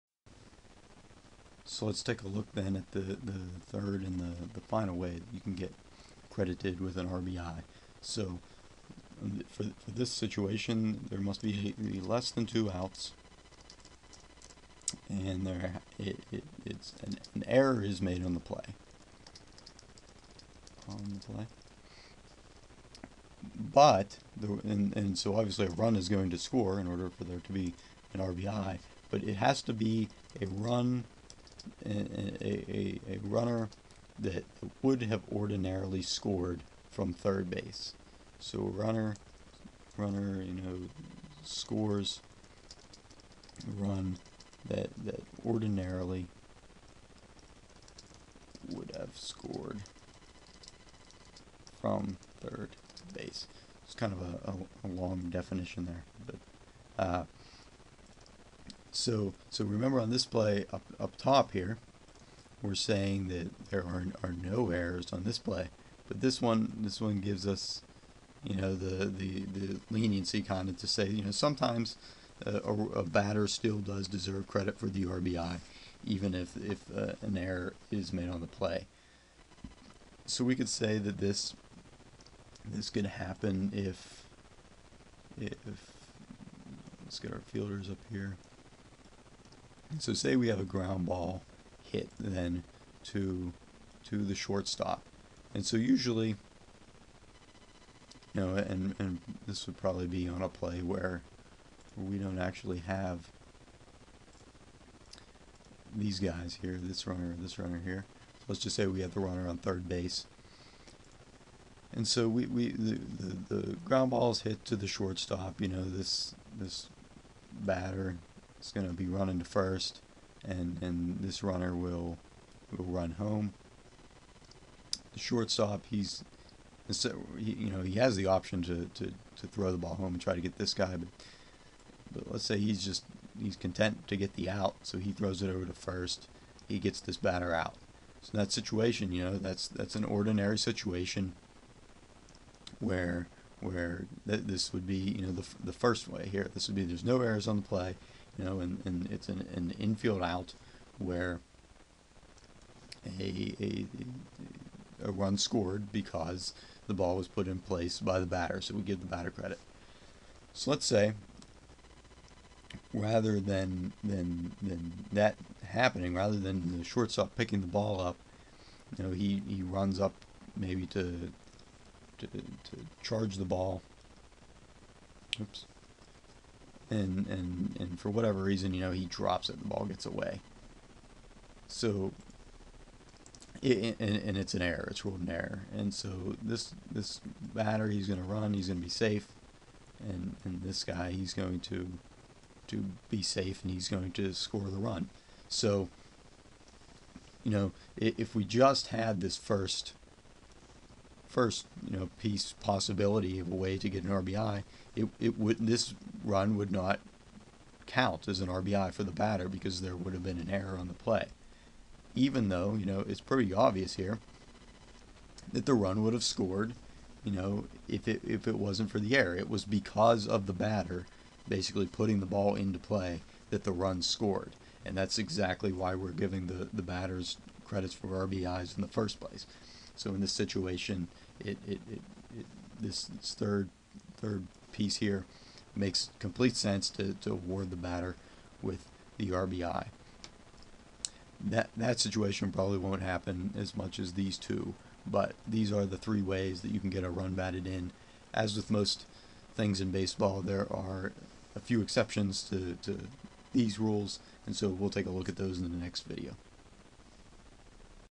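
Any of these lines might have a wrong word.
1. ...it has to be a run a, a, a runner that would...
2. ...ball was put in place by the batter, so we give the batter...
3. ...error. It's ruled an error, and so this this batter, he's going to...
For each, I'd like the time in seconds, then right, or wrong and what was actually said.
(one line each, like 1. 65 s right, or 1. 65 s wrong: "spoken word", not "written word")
1. 29 s right
2. 156 s right
3. 184 s right.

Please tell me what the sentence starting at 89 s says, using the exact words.
So say we have a ground ball hit then to to the shortstop.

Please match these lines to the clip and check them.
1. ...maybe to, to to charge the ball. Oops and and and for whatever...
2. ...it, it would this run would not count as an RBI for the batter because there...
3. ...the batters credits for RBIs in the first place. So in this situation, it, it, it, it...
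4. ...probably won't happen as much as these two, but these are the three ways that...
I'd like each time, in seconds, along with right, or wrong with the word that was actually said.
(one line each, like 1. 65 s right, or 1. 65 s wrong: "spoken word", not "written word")
1. 170 s right
2. 204 s right
3. 226 s right
4. 242 s right.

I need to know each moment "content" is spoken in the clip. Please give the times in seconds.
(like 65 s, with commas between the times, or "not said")
133 s.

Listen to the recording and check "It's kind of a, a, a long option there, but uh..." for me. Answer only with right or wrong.
wrong.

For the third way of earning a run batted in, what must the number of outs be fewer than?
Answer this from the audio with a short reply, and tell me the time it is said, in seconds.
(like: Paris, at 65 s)
2, at 12 s.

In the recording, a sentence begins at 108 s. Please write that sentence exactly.
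So let's just say we have the runner on third base.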